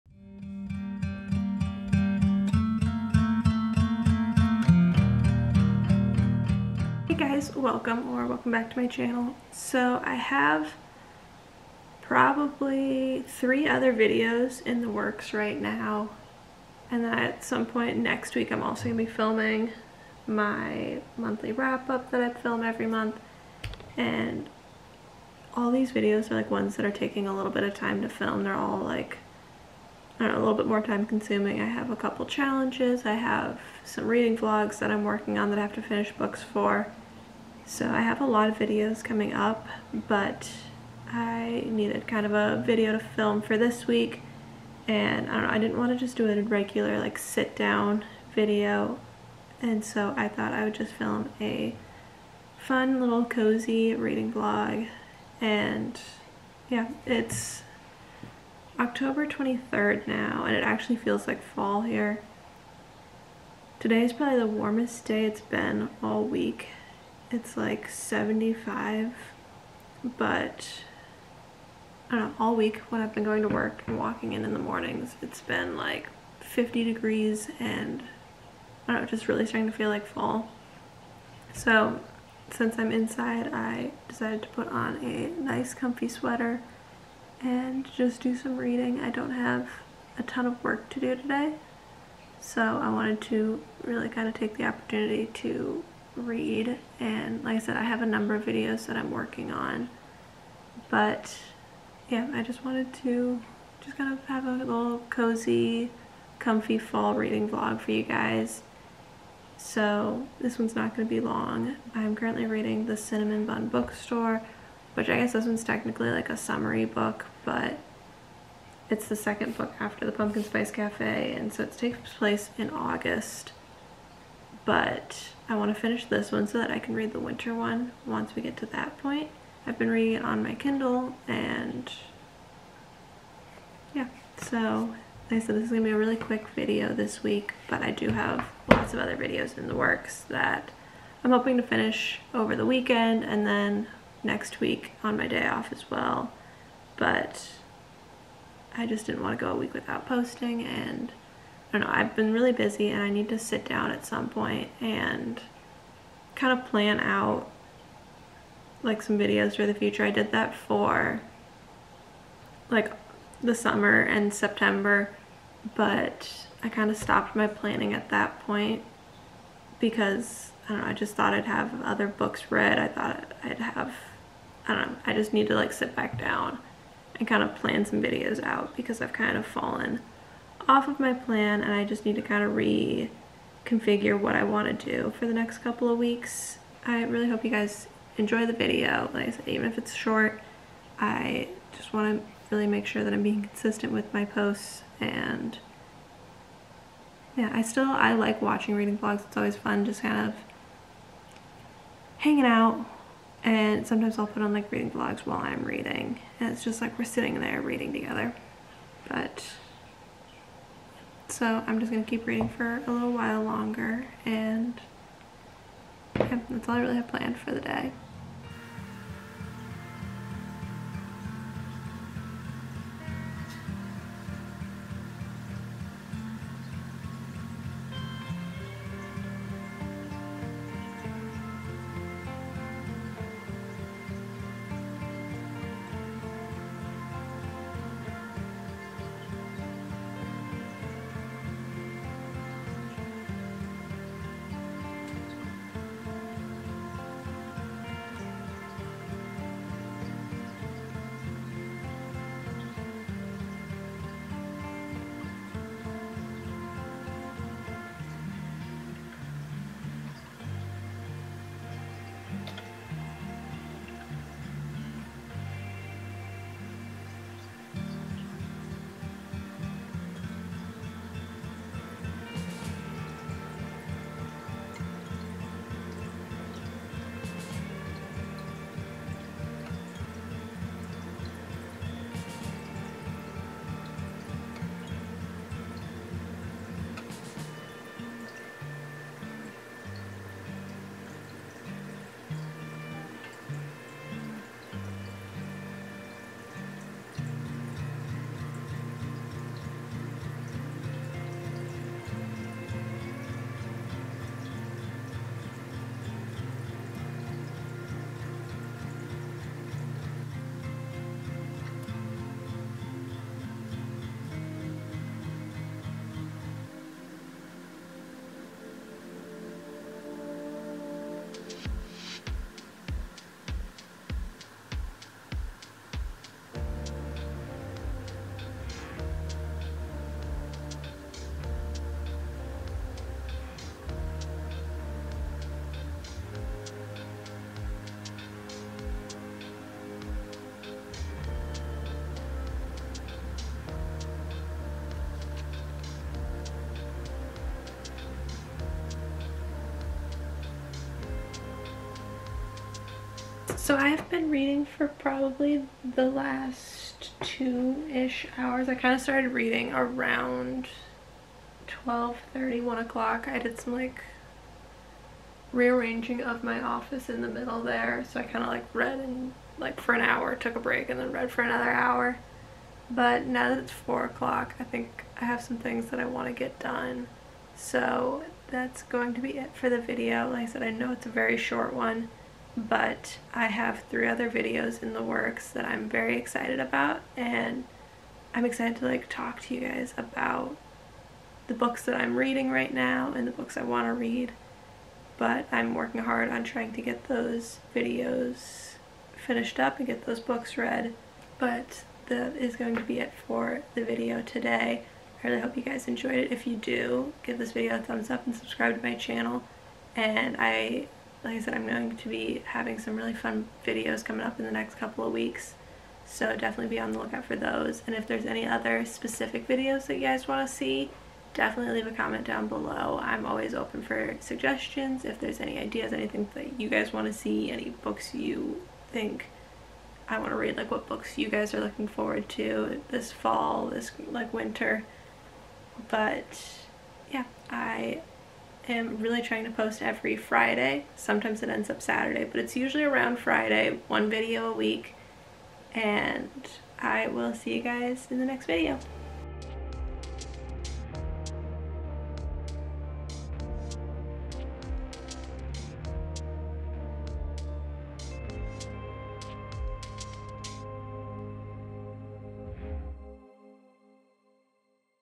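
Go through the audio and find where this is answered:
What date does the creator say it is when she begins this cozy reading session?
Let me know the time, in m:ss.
0:58.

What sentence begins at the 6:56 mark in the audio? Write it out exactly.
So definitely be on the lookout for those.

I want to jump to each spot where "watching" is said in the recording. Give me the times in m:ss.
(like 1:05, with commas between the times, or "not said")
3:18.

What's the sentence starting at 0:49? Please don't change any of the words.
And so I thought I would just film a fun little cozy reading vlog.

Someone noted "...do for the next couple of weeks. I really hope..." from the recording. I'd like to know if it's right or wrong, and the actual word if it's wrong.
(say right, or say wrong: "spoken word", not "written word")
right.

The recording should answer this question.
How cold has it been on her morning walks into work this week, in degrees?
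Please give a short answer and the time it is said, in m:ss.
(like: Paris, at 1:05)
50 degrees, at 1:16.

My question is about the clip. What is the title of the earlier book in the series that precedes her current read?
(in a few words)
The Pumpkin Spice Cafe.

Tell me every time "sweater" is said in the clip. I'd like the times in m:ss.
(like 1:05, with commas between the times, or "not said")
1:26.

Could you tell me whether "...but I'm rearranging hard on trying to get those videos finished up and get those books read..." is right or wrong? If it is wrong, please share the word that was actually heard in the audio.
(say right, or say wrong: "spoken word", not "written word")
wrong: "working", not "rearranging".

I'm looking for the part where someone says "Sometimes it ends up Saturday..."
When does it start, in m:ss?
7:20.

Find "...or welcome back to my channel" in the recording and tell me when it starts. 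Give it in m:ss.
0:08.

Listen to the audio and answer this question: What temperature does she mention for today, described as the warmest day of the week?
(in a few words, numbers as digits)
75.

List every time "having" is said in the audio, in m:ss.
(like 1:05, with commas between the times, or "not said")
6:52.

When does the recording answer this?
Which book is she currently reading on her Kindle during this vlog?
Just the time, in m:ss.
1:52.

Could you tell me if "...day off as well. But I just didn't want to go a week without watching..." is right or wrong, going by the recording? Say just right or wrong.
wrong.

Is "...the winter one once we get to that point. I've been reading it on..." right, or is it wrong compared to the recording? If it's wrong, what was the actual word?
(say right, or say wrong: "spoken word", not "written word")
right.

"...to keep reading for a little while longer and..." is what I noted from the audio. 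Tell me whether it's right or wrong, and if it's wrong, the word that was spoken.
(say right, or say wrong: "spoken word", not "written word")
right.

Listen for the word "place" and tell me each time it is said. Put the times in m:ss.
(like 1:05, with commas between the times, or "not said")
2:02.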